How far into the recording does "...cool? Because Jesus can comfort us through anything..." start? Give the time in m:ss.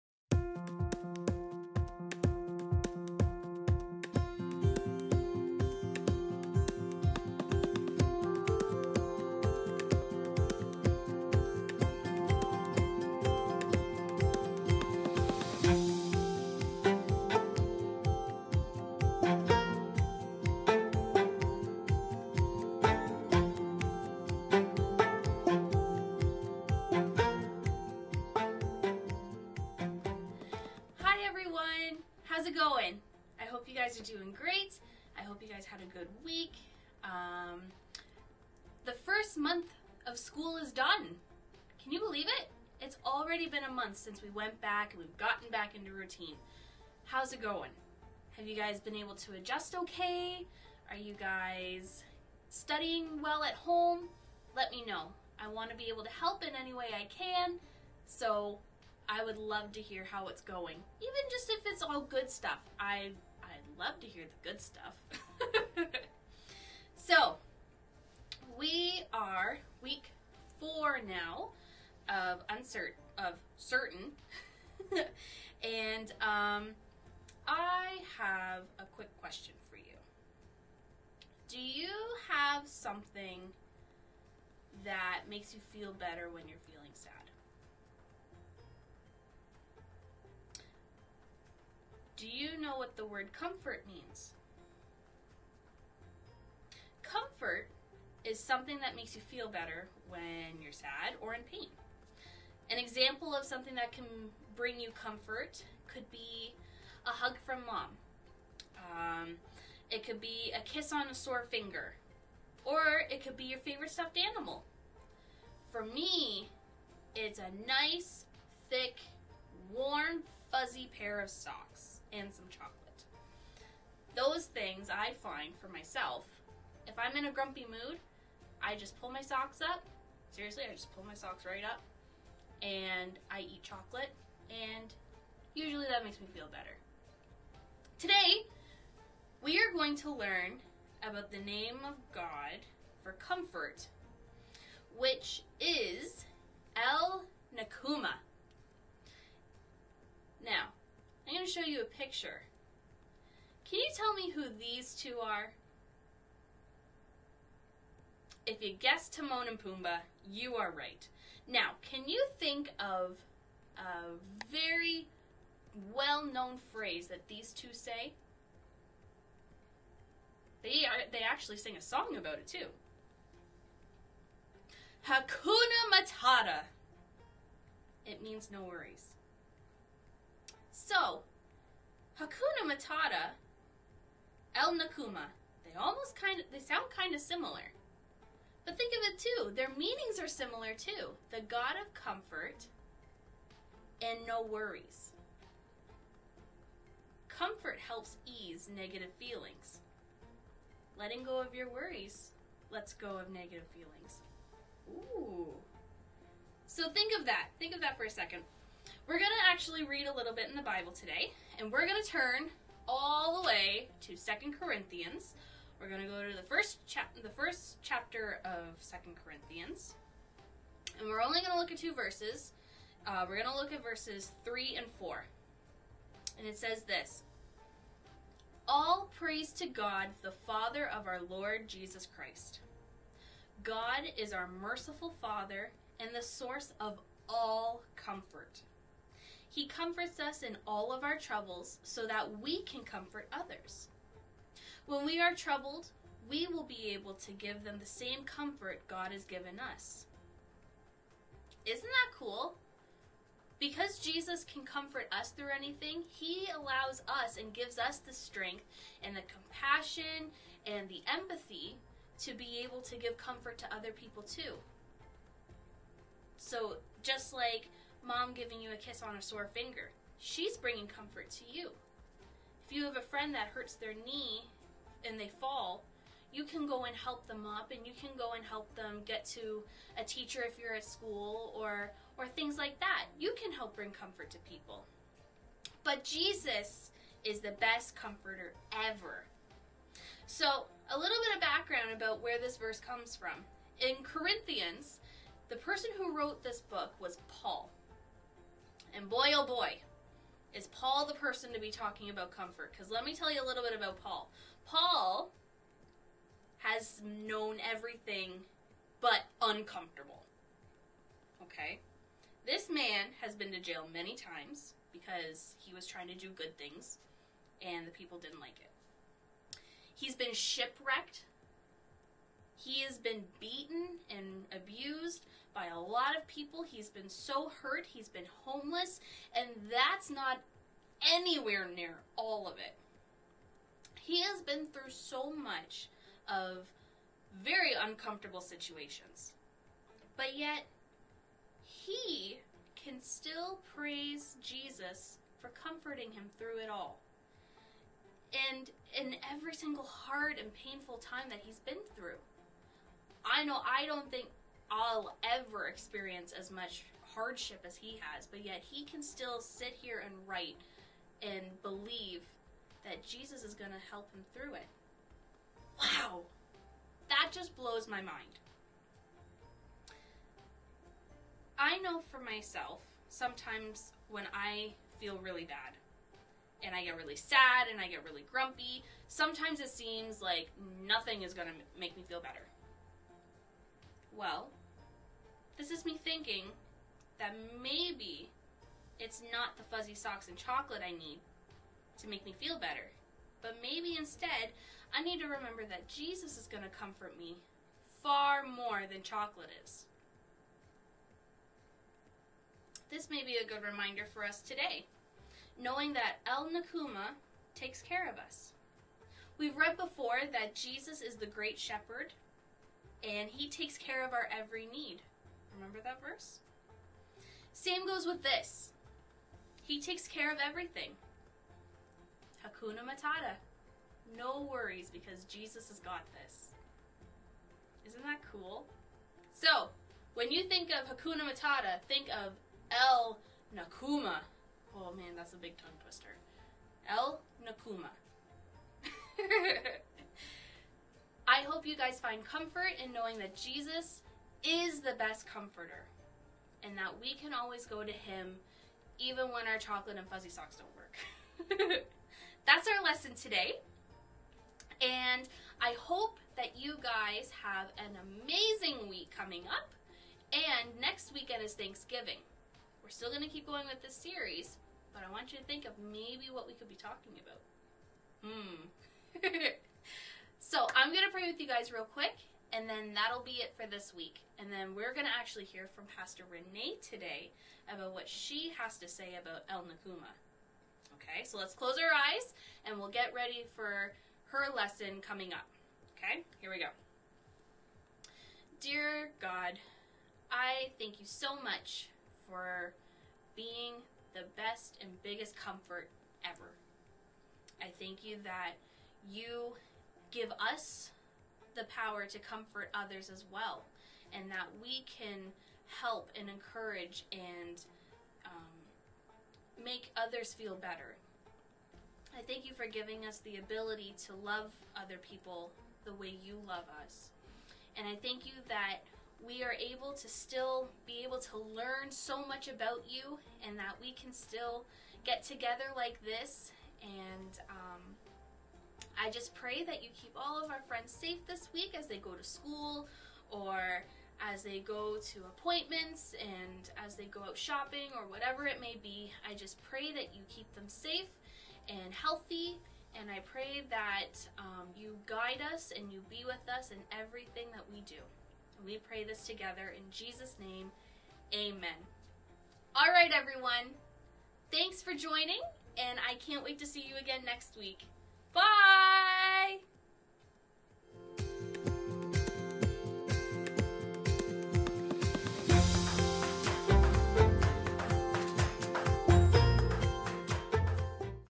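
4:12.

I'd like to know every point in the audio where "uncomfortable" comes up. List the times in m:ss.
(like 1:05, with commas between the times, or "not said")
5:09, 5:37.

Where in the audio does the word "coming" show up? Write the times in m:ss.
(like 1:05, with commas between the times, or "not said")
7:39, 8:05.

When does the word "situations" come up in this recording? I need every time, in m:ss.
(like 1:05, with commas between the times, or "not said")
5:38.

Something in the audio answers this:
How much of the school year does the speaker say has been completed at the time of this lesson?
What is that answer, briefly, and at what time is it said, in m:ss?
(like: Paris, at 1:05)
first month, at 0:38.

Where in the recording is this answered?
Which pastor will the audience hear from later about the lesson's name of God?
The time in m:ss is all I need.
7:55.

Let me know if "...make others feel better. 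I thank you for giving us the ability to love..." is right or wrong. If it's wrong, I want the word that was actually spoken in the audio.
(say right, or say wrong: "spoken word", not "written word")
right.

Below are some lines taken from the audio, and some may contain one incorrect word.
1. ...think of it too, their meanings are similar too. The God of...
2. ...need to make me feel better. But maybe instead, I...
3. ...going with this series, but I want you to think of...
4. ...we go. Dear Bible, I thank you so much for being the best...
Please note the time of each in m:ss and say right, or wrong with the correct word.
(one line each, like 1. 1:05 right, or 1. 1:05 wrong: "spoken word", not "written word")
1. 3:08 right
2. 6:30 right
3. 7:43 right
4. 8:06 wrong: "God", not "Bible".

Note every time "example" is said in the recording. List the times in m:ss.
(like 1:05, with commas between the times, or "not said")
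1:42.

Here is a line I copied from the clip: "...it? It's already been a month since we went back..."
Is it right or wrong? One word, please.
right.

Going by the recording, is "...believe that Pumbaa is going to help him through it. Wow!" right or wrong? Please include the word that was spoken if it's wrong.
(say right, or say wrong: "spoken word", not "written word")
wrong: "Jesus", not "Pumbaa".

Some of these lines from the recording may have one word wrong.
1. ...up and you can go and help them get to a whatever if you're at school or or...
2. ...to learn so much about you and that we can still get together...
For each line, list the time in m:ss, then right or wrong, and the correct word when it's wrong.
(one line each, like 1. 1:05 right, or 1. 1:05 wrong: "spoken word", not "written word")
1. 4:37 wrong: "teacher", not "whatever"
2. 8:41 right.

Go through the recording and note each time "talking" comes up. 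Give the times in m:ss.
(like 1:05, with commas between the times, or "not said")
5:01, 7:46.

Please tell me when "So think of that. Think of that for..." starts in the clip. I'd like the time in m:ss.
3:26.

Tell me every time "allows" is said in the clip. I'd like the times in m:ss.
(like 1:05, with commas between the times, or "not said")
4:16.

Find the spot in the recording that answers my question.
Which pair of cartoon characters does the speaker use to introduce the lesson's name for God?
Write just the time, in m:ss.
2:39.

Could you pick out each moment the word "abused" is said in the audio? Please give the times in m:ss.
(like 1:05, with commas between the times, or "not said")
5:24.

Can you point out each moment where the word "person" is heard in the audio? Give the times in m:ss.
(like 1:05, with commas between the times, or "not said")
4:55, 5:01.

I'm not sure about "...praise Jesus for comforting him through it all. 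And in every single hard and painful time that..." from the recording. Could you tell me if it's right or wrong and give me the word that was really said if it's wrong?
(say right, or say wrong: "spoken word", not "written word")
right.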